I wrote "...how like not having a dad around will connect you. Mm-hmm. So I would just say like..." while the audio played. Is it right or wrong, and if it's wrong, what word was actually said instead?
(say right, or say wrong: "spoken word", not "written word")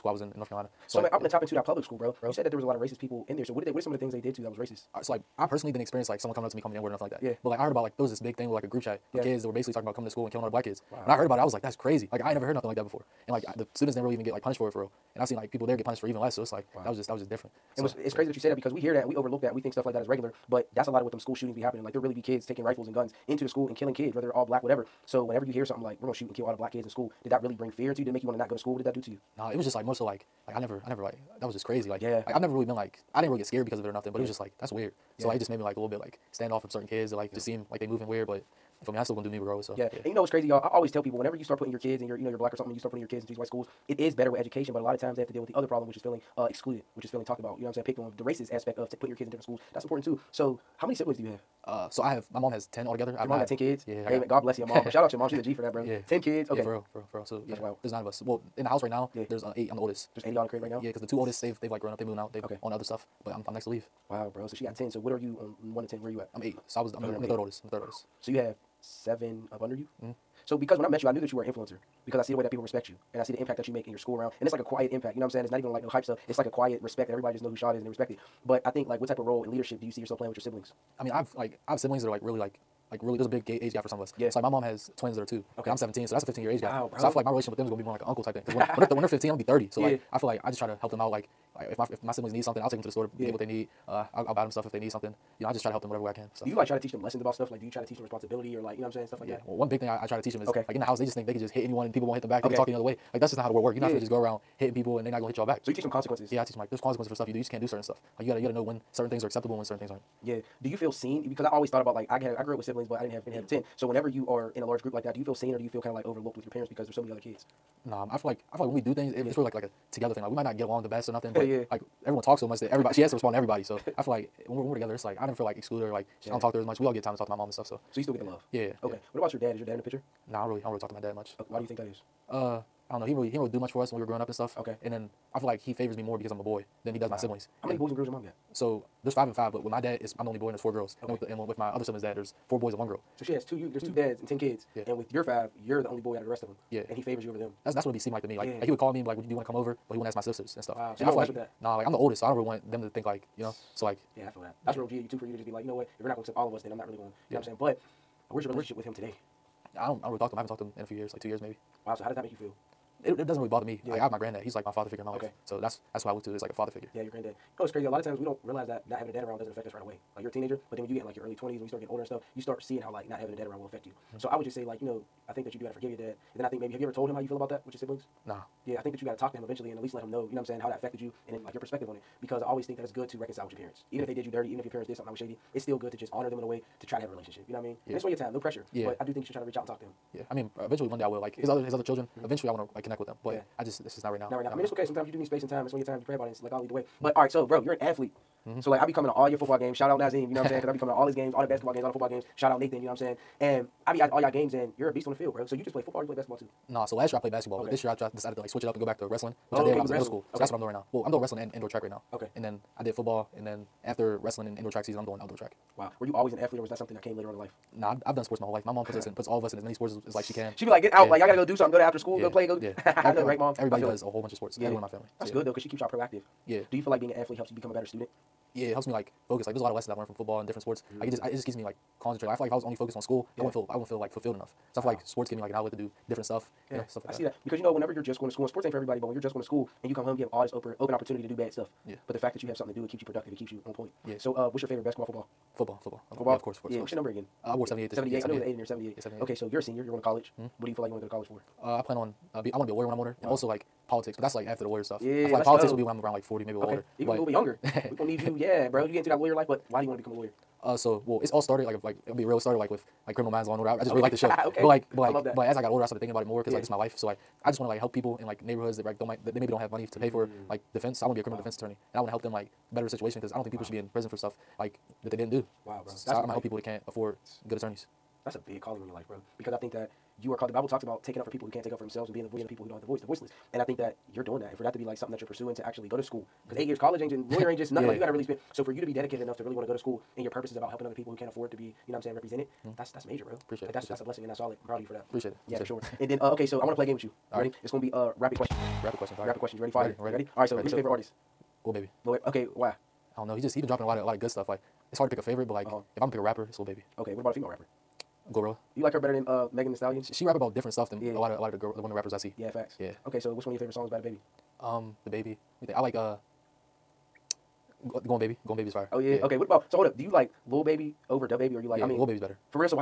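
wrong: "affect", not "connect".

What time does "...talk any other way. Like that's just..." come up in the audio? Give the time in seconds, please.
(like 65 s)
102 s.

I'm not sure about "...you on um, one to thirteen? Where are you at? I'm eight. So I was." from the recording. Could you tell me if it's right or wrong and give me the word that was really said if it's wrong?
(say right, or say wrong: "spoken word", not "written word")
wrong: "ten", not "thirteen".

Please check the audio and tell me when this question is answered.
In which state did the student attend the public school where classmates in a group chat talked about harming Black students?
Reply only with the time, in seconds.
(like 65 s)
0 s.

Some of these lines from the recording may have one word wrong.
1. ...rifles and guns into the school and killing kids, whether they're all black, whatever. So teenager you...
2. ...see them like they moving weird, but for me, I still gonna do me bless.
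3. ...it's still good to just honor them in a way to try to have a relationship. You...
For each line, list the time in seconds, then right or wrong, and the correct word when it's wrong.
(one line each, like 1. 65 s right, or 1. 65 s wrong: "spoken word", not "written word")
1. 22 s wrong: "whenever", not "teenager"
2. 37 s wrong: "regardless", not "bless"
3. 185 s right.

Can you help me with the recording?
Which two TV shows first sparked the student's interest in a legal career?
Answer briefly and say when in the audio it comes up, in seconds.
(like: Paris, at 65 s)
Criminal Minds, Law and Order, at 263 s.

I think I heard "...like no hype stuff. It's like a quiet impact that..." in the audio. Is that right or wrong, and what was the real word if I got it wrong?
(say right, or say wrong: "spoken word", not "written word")
wrong: "respect", not "impact".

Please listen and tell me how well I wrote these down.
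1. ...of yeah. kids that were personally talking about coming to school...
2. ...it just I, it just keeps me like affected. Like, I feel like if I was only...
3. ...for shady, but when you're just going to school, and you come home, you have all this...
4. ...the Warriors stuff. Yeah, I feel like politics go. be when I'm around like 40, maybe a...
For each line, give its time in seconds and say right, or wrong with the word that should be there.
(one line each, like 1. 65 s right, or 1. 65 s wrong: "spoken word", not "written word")
1. 9 s wrong: "basically", not "personally"
2. 231 s wrong: "concentrated", not "affected"
3. 238 s wrong: "everybody", not "shady"
4. 254 s right.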